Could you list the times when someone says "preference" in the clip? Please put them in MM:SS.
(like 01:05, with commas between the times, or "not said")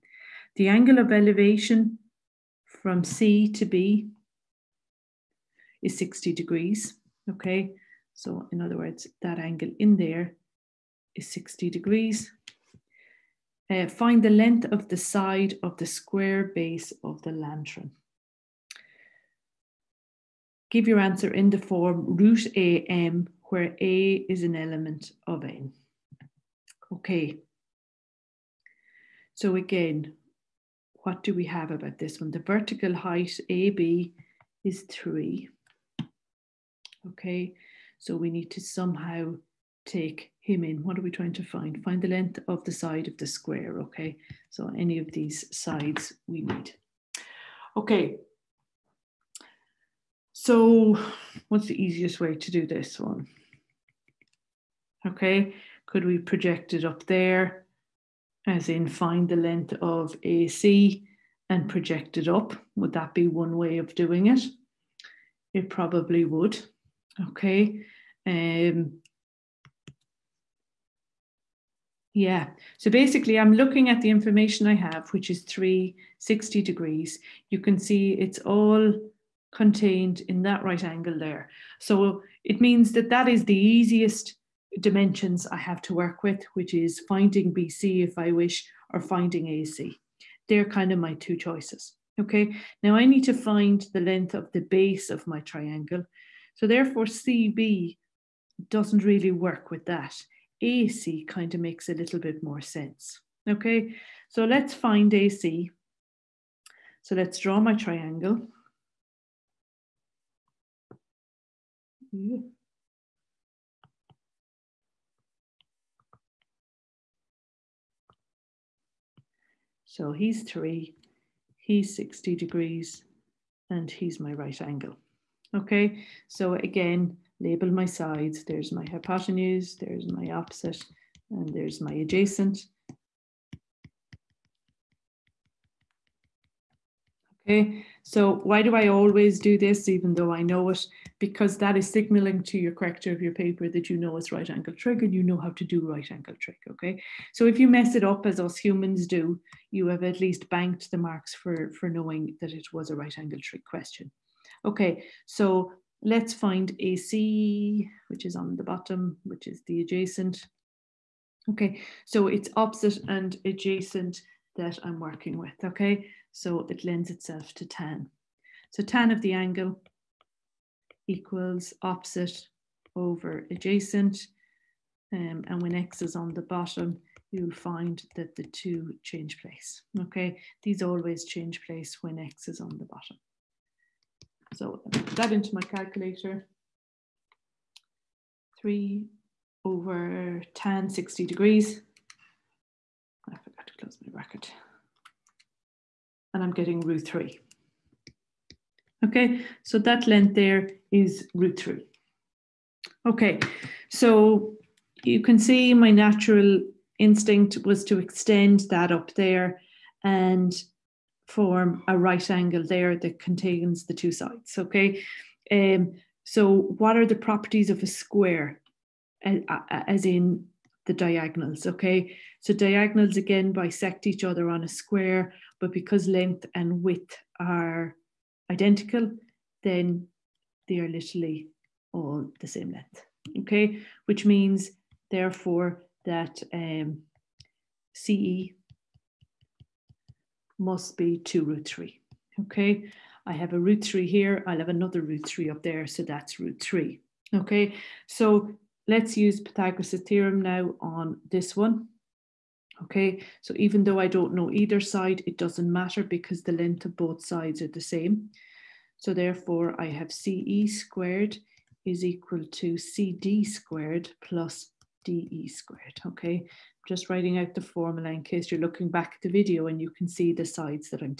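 not said.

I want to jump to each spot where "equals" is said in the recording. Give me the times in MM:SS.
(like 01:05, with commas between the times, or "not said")
02:51, 04:22.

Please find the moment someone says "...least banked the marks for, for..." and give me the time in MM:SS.
02:30.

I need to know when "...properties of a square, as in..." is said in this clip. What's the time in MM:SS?
03:37.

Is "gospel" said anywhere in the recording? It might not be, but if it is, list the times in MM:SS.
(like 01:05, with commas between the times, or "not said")
not said.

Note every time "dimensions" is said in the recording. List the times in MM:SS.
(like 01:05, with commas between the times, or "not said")
01:24.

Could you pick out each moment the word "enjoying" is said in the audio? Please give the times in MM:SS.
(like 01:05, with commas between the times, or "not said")
not said.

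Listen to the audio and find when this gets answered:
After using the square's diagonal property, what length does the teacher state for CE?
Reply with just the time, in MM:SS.
04:01.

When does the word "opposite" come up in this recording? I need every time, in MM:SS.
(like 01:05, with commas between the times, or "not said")
02:10, 02:42, 02:51.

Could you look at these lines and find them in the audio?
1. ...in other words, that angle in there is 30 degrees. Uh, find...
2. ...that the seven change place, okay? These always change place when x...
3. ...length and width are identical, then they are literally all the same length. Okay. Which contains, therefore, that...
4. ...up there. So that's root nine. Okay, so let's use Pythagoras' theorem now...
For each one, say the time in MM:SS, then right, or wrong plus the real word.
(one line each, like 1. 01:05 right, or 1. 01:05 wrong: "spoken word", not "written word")
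1. 00:08 wrong: "60", not "30"
2. 02:58 wrong: "two", not "seven"
3. 03:46 wrong: "means", not "contains"
4. 04:05 wrong: "three", not "nine".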